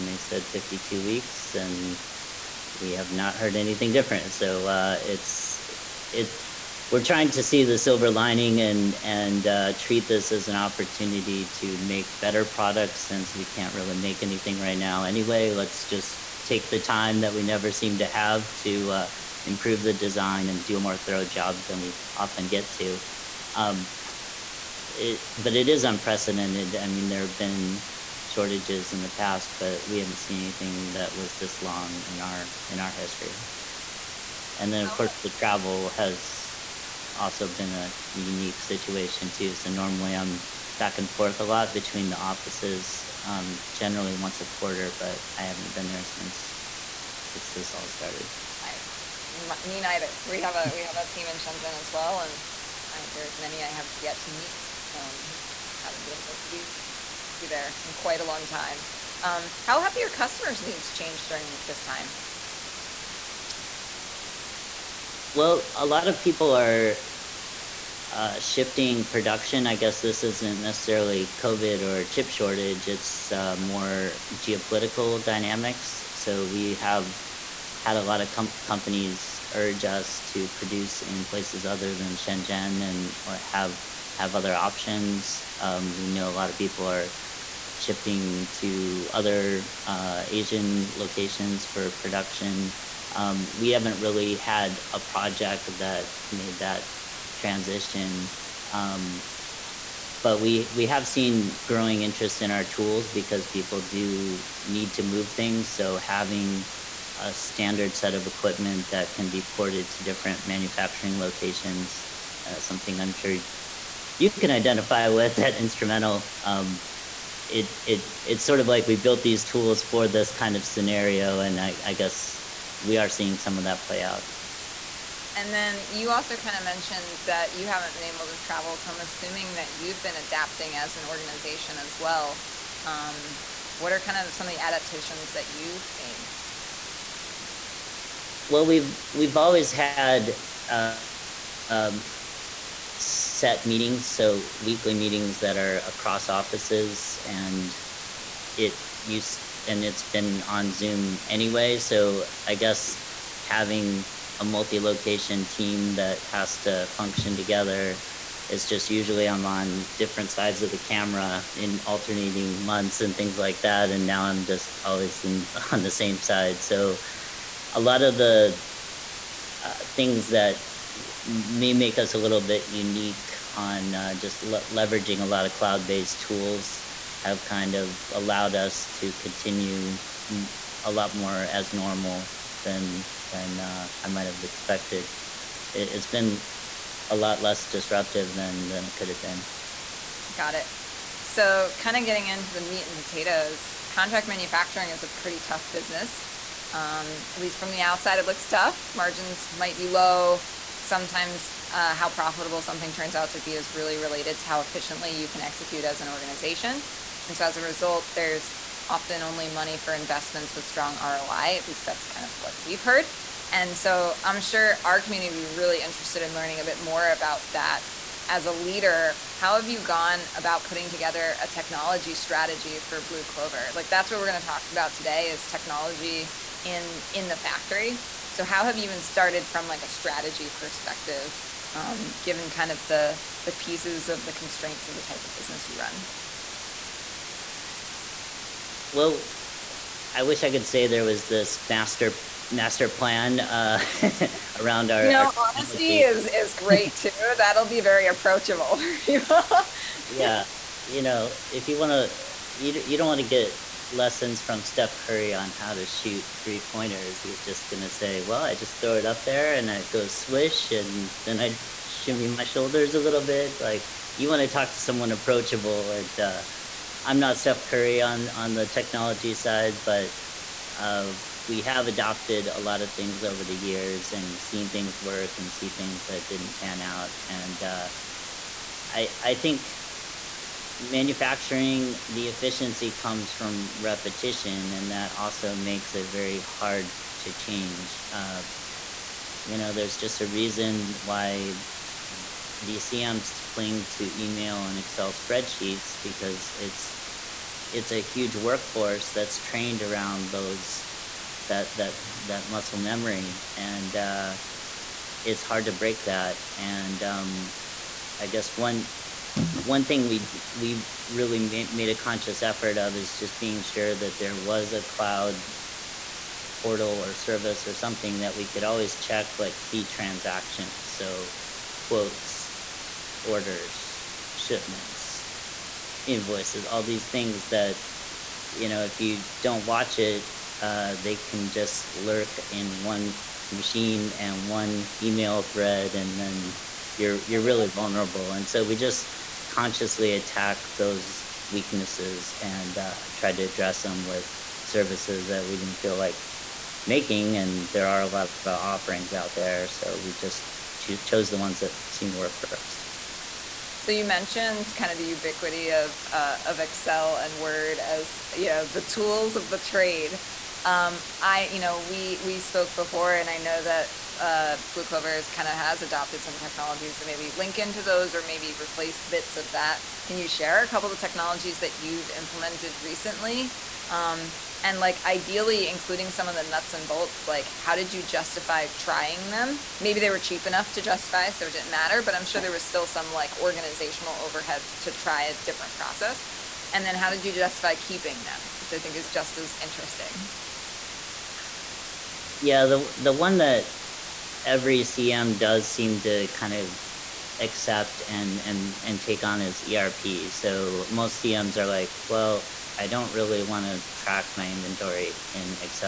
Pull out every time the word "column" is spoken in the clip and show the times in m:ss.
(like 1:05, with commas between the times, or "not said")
not said.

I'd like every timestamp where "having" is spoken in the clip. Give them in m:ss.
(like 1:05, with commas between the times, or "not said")
1:45, 2:33.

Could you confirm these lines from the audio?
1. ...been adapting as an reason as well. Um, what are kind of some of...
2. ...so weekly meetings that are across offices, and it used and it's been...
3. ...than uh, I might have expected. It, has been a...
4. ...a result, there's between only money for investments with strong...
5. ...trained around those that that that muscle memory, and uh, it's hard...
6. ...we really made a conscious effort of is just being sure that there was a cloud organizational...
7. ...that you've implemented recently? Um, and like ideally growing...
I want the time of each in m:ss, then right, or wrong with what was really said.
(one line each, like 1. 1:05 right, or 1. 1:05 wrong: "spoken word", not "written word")
1. 2:10 wrong: "organization", not "reason"
2. 2:24 right
3. 3:03 right
4. 3:27 wrong: "often", not "between"
5. 4:59 right
6. 5:10 wrong: "portal", not "organizational"
7. 6:11 wrong: "including", not "growing".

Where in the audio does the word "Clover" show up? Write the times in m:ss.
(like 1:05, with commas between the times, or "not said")
3:43, 6:04.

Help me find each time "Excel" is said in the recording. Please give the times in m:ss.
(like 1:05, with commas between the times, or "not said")
4:54, 5:56.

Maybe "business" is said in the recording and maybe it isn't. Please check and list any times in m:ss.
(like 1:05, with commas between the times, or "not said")
3:15, 3:55.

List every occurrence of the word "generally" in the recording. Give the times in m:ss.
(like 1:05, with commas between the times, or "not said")
0:43.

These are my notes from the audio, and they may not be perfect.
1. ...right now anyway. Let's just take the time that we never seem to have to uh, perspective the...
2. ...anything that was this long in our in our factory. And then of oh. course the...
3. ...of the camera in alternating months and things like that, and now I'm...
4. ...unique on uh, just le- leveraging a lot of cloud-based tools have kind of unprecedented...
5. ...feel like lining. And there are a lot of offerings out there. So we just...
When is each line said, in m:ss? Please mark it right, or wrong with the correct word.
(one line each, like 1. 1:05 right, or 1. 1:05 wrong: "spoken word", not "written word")
1. 0:14 wrong: "improve", not "perspective"
2. 0:30 wrong: "history", not "factory"
3. 2:40 right
4. 2:52 wrong: "allowed", not "unprecedented"
5. 5:45 wrong: "making", not "lining".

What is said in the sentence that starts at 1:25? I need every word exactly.
Um, we know a lot of people are shifting to other uh, Asian locations for production.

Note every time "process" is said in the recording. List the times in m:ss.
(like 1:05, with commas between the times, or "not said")
6:25.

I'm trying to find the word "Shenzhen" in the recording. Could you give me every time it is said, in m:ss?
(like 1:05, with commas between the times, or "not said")
0:51, 1:22.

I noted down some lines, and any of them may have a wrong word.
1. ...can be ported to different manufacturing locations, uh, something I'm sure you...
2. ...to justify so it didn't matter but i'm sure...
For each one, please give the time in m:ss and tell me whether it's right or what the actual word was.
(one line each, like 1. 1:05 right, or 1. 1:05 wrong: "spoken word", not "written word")
1. 1:49 right
2. 6:20 right.